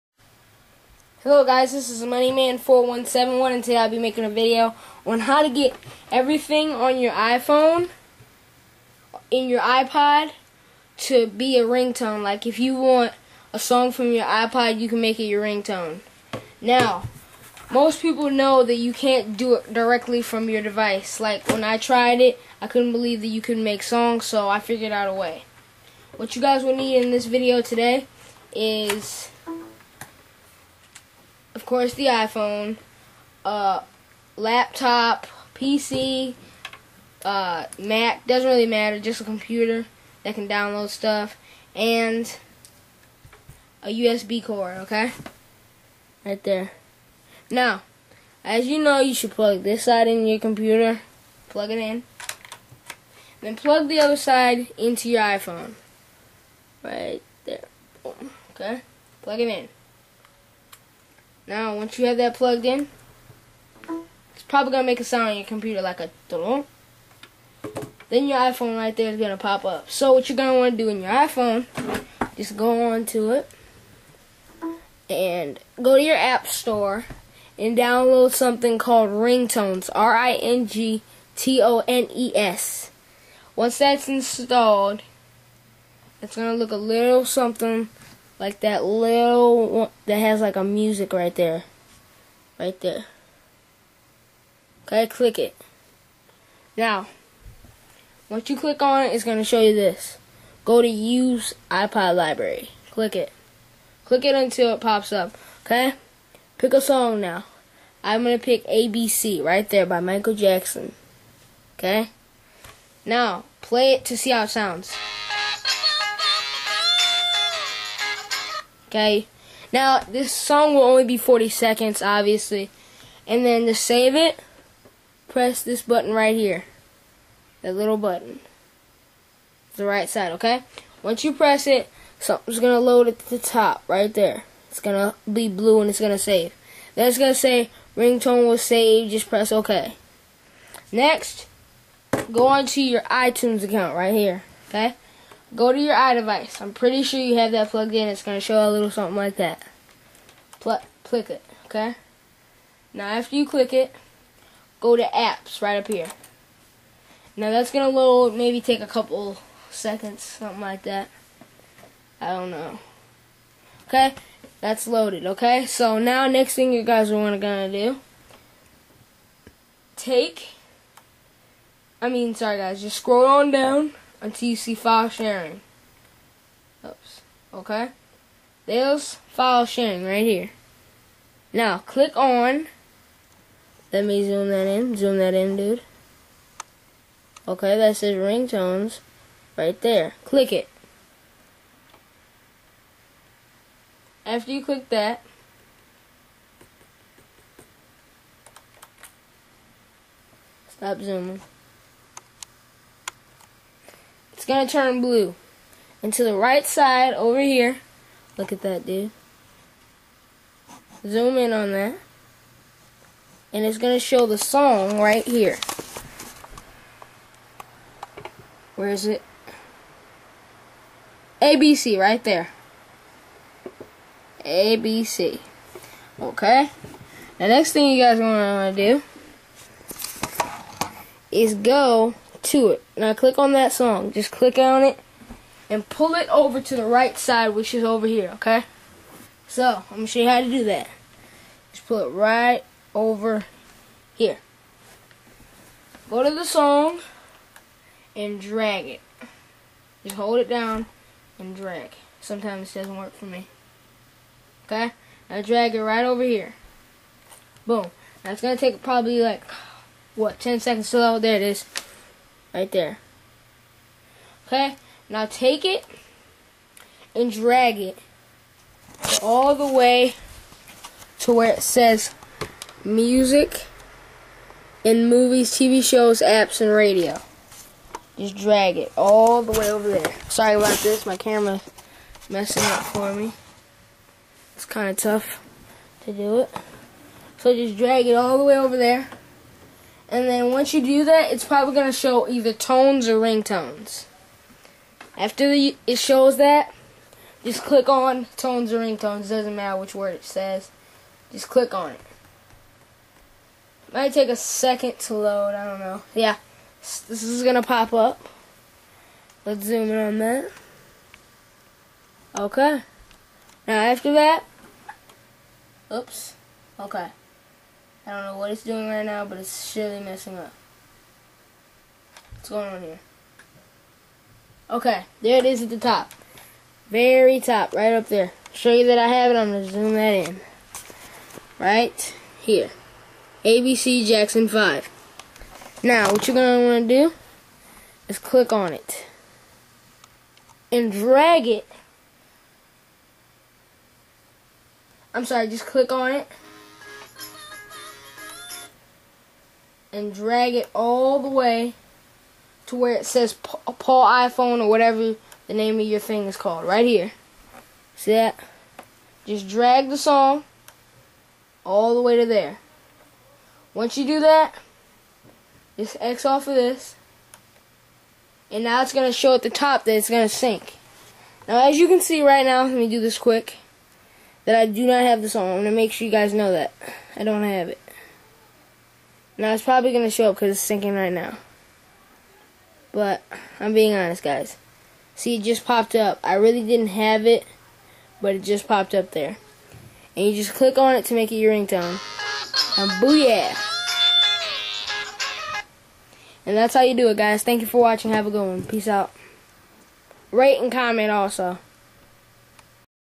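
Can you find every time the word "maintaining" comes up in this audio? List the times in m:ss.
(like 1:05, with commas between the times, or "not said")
not said.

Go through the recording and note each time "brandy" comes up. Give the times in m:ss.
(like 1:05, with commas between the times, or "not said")
not said.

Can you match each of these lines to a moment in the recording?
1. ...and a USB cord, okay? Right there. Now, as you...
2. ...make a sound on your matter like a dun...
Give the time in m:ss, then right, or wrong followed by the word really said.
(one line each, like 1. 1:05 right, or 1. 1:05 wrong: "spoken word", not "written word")
1. 0:41 right
2. 1:04 wrong: "computer", not "matter".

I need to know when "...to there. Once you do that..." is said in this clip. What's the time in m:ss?
6:02.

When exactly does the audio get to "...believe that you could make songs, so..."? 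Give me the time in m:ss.
0:22.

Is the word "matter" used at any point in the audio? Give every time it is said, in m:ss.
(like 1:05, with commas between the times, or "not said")
0:38, 4:59.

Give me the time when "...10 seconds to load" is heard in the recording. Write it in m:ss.
4:20.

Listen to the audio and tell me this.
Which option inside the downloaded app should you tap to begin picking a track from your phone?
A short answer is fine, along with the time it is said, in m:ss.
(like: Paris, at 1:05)
Use iPod library, at 1:40.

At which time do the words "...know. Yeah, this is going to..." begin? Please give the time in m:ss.
5:05.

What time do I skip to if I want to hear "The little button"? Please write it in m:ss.
2:07.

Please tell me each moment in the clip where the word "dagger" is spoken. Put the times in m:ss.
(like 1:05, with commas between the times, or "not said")
not said.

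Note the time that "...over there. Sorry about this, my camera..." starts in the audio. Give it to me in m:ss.
4:39.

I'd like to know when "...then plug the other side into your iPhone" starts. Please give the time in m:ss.
0:53.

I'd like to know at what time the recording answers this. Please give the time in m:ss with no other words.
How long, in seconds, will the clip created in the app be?
2:01.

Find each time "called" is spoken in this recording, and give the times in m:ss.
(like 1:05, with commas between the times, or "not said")
1:18, 5:56.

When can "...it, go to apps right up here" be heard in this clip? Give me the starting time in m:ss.
2:33.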